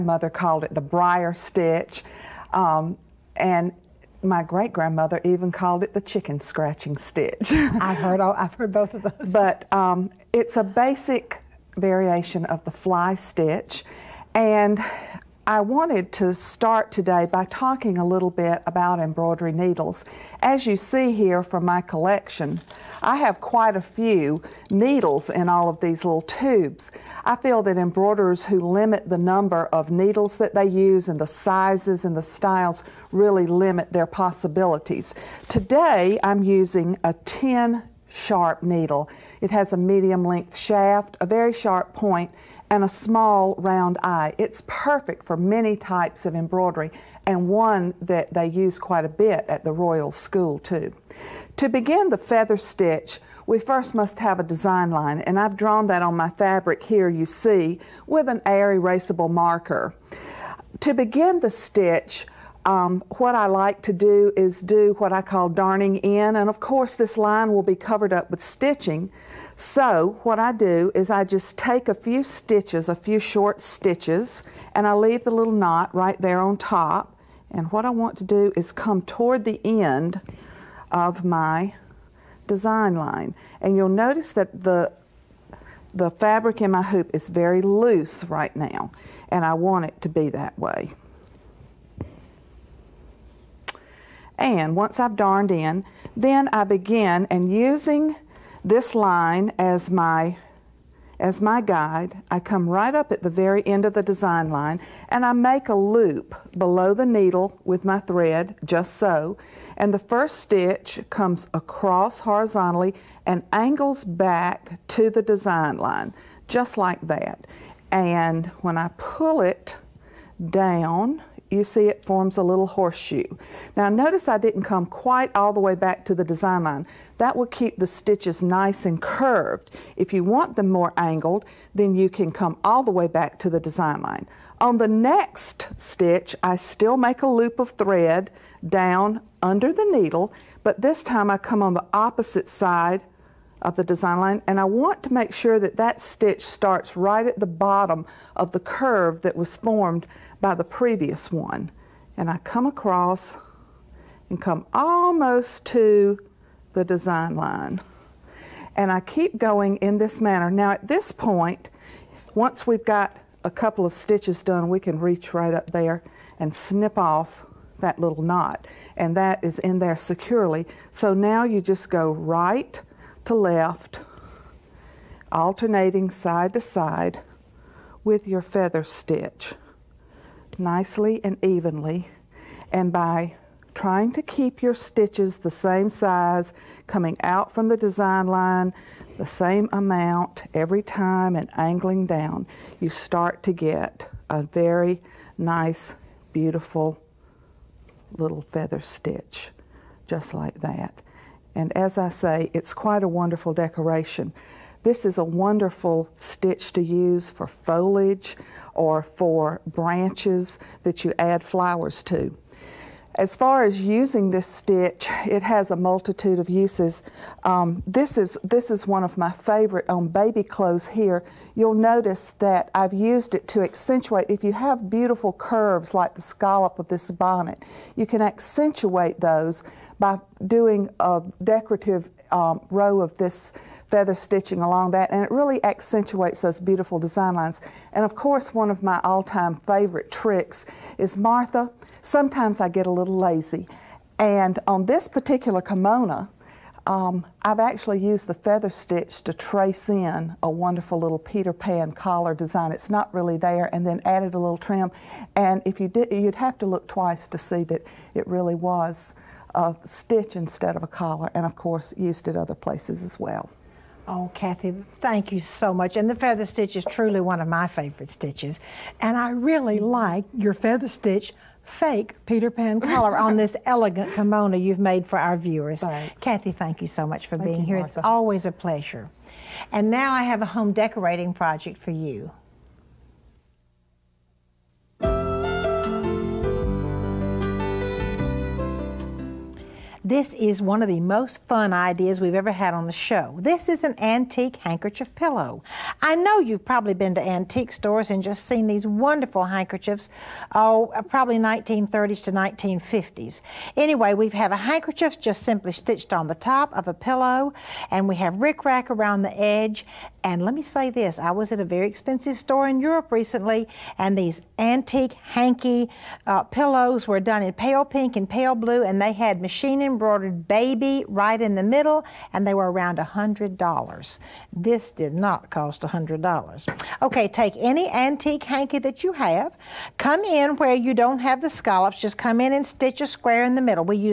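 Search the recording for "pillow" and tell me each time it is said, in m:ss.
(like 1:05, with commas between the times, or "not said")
4:55, 5:06, 5:16.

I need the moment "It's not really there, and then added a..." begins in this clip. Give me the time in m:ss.
4:12.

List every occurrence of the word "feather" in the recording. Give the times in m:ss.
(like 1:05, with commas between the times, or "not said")
0:52, 2:58, 3:18, 3:53, 4:08, 4:26, 4:30.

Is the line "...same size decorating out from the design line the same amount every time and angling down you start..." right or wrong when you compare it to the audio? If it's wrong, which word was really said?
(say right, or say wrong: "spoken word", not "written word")
wrong: "coming", not "decorating".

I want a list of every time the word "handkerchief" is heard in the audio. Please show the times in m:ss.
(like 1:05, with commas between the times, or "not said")
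4:54, 4:59, 5:04.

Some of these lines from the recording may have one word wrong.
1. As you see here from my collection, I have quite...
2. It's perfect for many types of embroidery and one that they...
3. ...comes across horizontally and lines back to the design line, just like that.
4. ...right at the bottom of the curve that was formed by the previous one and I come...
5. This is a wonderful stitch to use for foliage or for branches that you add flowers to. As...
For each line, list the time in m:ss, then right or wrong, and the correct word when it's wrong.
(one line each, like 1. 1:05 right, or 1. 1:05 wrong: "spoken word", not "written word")
1. 0:20 right
2. 0:44 right
3. 1:51 wrong: "angles", not "lines"
4. 2:26 right
5. 3:24 right.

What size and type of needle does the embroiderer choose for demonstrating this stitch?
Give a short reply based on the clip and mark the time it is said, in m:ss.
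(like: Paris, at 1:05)
10 sharp, at 0:37.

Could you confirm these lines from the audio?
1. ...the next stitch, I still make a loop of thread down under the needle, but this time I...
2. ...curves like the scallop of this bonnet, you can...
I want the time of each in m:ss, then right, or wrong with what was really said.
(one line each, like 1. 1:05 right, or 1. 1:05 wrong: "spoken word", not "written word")
1. 2:14 right
2. 3:45 right.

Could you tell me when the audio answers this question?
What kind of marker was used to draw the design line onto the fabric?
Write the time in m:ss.
0:58.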